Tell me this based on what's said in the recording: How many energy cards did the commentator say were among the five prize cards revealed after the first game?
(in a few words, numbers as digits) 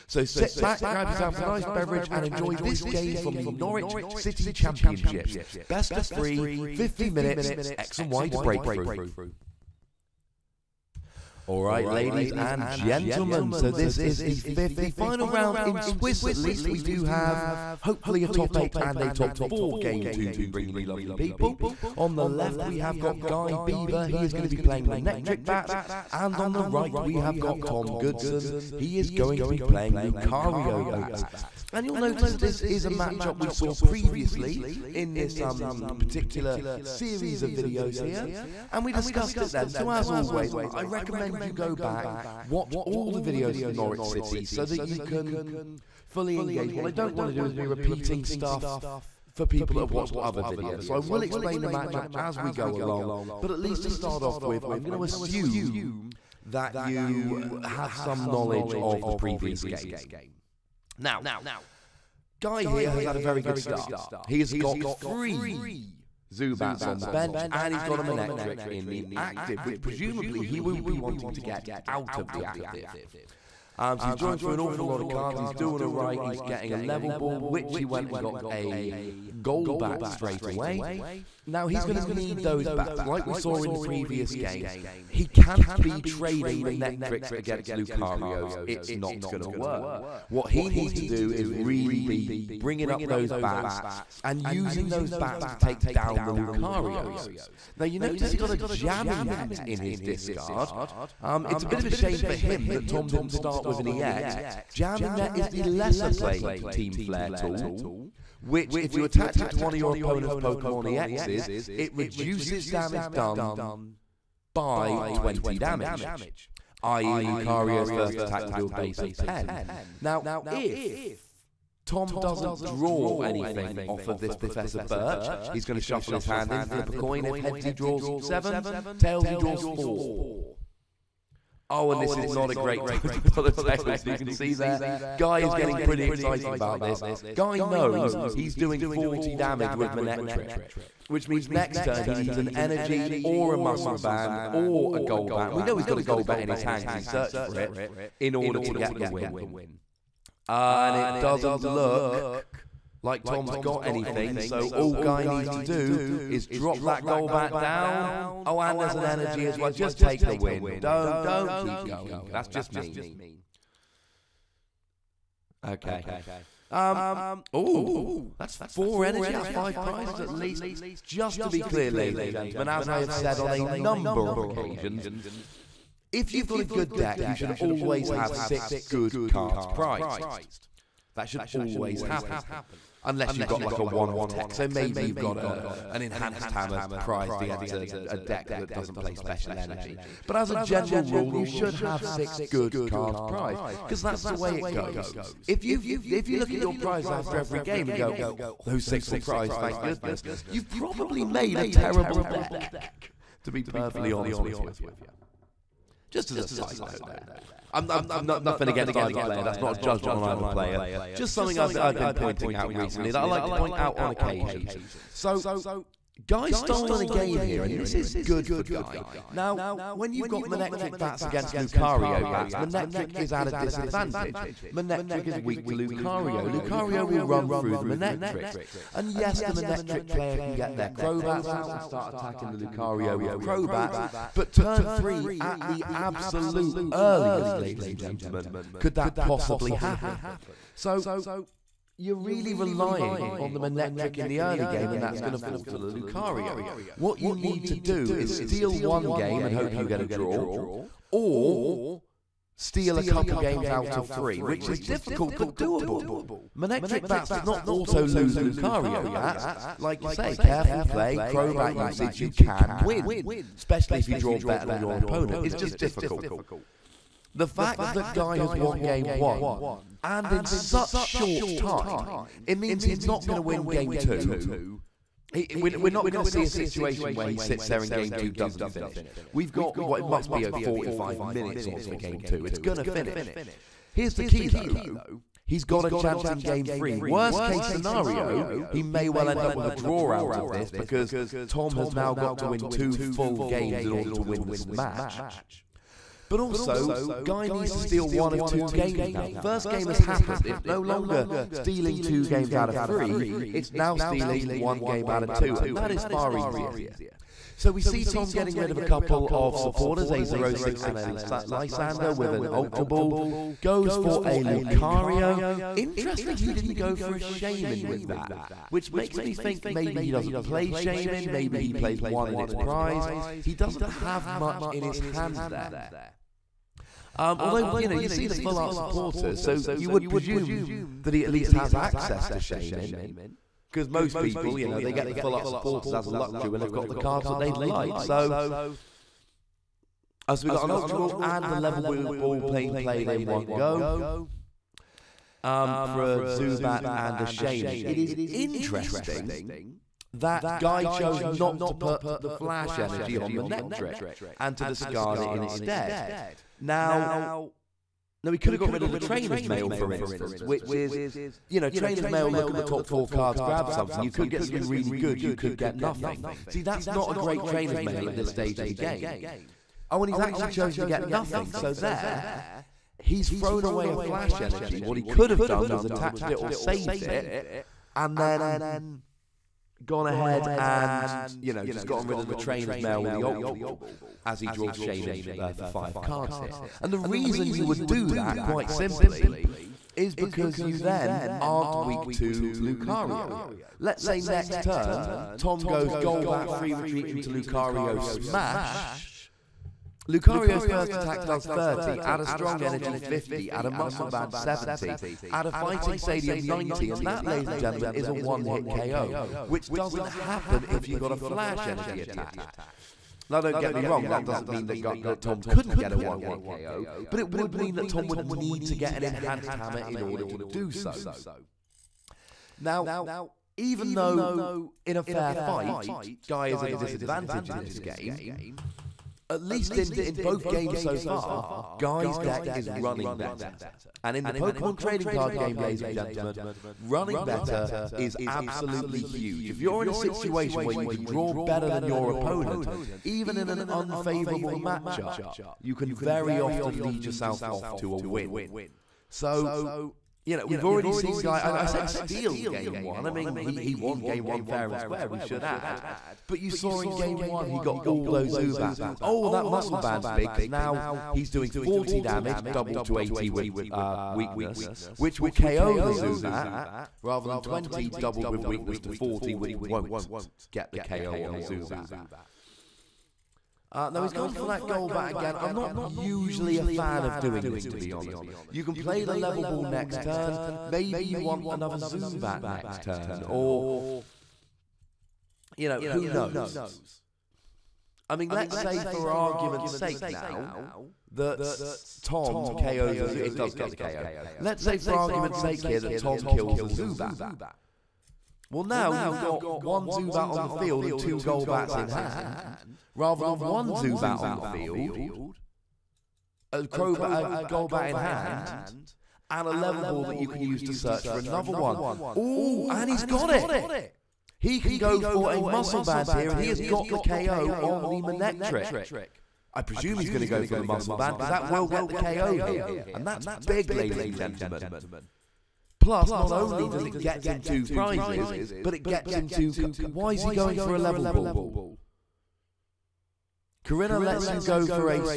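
4.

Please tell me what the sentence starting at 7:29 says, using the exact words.
So, you know, we've already seen guy.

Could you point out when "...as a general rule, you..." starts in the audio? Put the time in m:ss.
3:10.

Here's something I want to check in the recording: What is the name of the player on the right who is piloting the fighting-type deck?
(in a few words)
Tom Goodson.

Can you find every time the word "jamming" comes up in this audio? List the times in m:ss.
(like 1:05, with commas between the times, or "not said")
1:38, 1:44.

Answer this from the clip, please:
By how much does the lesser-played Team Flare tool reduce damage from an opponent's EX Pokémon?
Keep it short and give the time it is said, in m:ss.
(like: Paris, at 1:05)
20, at 1:55.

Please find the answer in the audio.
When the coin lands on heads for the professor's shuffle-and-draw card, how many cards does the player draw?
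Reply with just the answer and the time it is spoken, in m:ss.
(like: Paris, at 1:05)
7, at 2:07.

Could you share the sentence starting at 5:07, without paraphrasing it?
So we see Tom getting rid of a couple of supporters, a Xerosic and a Lysander with an Ultra Ball.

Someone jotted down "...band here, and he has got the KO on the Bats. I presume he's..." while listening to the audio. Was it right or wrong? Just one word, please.
wrong.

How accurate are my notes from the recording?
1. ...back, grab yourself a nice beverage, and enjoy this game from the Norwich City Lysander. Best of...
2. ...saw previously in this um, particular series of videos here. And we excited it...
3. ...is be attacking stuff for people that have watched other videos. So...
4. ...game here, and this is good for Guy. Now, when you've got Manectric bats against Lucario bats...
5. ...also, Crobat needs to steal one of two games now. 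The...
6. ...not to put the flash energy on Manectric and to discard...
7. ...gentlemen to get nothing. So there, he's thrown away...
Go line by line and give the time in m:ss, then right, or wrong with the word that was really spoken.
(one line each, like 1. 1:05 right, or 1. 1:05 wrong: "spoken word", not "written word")
1. 0:00 wrong: "Championships", not "Lysander"
2. 0:33 wrong: "discussed", not "excited"
3. 0:47 wrong: "repeating", not "attacking"
4. 3:37 right
5. 4:56 wrong: "Guy", not "Crobat"
6. 5:51 right
7. 6:10 wrong: "chosen", not "gentlemen".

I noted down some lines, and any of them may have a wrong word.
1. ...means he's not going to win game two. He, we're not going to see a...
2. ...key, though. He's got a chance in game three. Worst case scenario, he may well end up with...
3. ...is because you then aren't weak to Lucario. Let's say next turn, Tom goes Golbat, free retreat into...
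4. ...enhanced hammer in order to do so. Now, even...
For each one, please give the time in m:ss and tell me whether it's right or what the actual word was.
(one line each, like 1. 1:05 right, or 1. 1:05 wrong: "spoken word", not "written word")
1. 4:32 right
2. 4:44 right
3. 6:29 right
4. 6:59 right.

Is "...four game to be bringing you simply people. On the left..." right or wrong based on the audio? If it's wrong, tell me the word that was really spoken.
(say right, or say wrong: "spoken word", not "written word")
wrong: "lovely", not "simply".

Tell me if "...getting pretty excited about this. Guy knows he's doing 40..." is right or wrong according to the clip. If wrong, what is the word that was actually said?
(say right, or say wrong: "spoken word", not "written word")
right.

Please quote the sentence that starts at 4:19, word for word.
Like you say, careful play, Crobat usage, you can win, especially if you draw better than your opponent.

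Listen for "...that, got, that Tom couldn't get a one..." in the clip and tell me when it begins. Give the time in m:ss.
6:54.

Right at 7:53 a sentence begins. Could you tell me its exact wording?
Uh, now he's gone for that Golbat again.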